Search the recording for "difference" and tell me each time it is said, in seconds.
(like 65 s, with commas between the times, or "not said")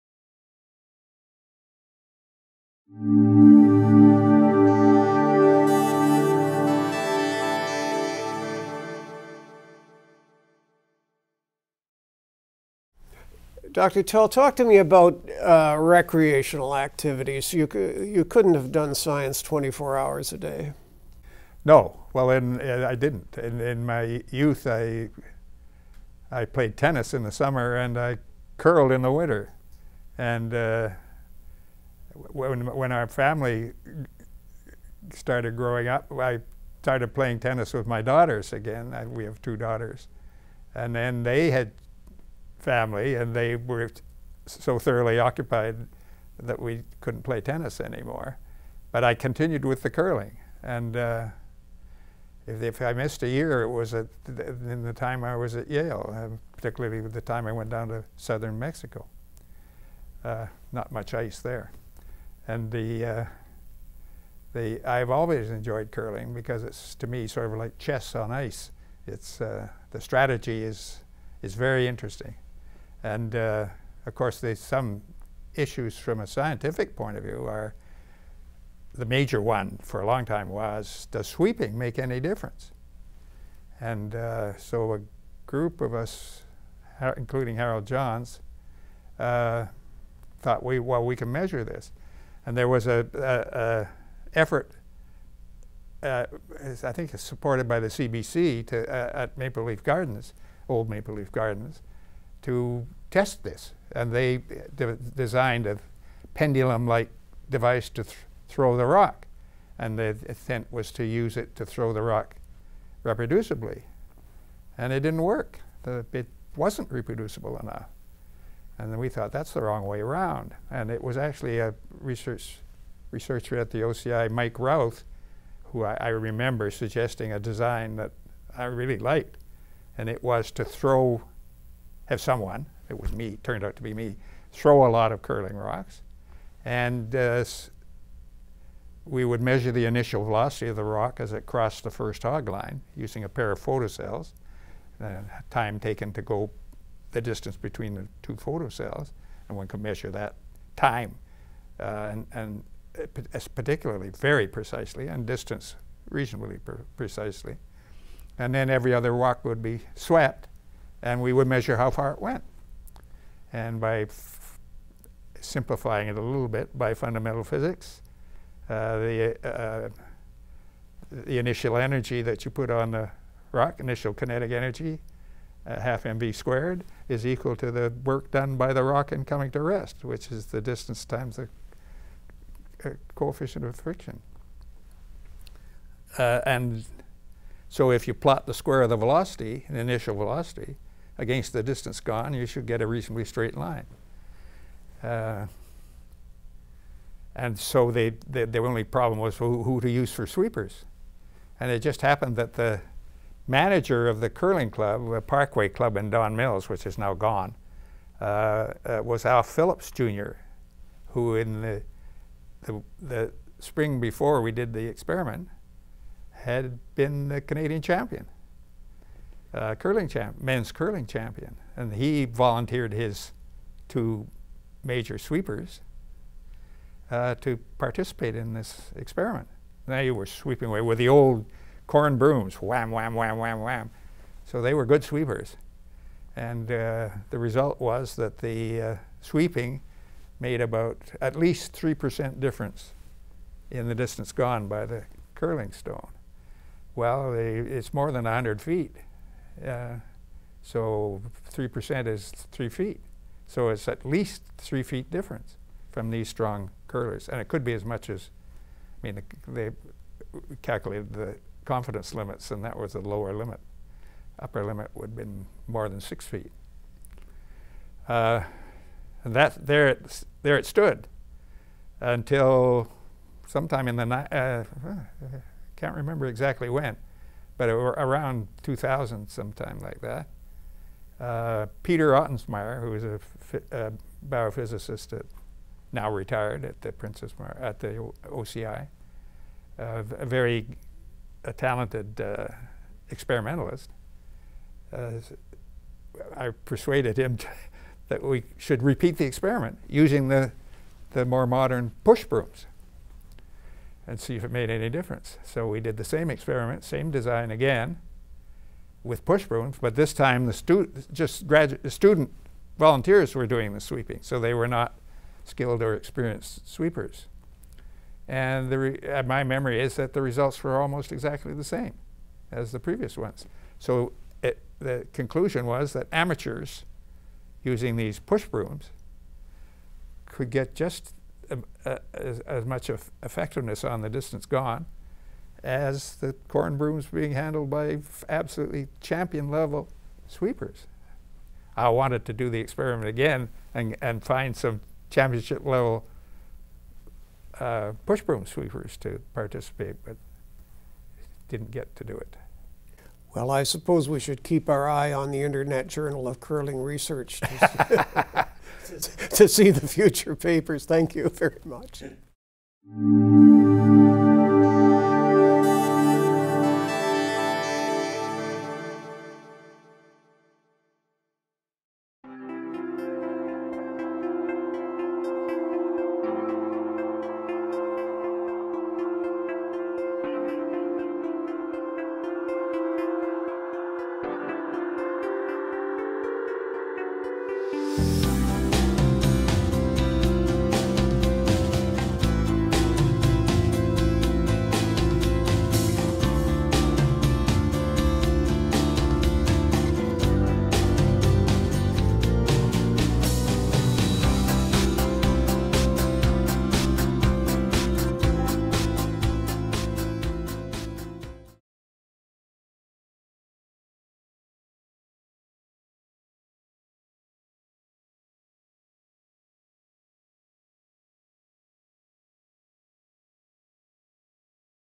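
82 s, 242 s, 255 s, 304 s.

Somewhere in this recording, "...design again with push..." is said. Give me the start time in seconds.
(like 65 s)
307 s.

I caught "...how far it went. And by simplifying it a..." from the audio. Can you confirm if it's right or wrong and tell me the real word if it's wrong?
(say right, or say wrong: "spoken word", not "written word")
right.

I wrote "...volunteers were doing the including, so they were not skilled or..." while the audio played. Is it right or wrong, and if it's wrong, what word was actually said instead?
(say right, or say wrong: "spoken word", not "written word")
wrong: "sweeping", not "including".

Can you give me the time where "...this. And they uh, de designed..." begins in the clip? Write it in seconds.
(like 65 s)
103 s.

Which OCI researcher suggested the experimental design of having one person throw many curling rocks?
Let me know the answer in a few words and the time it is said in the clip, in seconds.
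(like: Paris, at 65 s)
Mike Routh, at 124 s.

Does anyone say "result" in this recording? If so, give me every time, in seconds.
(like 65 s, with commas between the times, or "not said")
237 s, 320 s.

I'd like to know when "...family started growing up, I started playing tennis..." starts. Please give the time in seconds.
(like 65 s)
33 s.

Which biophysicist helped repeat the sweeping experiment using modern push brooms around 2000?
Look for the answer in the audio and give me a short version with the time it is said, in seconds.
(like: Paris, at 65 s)
Peter Ottensmeyer, at 281 s.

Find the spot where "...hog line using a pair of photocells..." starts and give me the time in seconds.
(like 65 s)
142 s.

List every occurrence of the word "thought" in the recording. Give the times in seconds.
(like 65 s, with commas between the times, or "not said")
90 s, 119 s.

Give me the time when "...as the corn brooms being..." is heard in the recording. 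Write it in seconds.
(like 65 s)
335 s.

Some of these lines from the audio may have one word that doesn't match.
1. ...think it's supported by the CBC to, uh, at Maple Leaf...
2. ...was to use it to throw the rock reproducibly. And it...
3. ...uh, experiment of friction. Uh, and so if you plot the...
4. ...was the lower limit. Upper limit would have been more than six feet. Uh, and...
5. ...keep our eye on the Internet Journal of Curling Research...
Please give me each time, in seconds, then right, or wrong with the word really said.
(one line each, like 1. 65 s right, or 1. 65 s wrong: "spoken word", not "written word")
1. 96 s right
2. 110 s right
3. 182 s wrong: "coefficient", not "experiment"
4. 262 s right
5. 354 s right.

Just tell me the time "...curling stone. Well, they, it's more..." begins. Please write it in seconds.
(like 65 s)
245 s.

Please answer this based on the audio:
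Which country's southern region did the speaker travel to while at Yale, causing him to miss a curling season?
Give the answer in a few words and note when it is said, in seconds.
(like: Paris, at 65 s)
Mexico, at 58 s.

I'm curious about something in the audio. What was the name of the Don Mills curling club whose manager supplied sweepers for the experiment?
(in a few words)
Parkway Club.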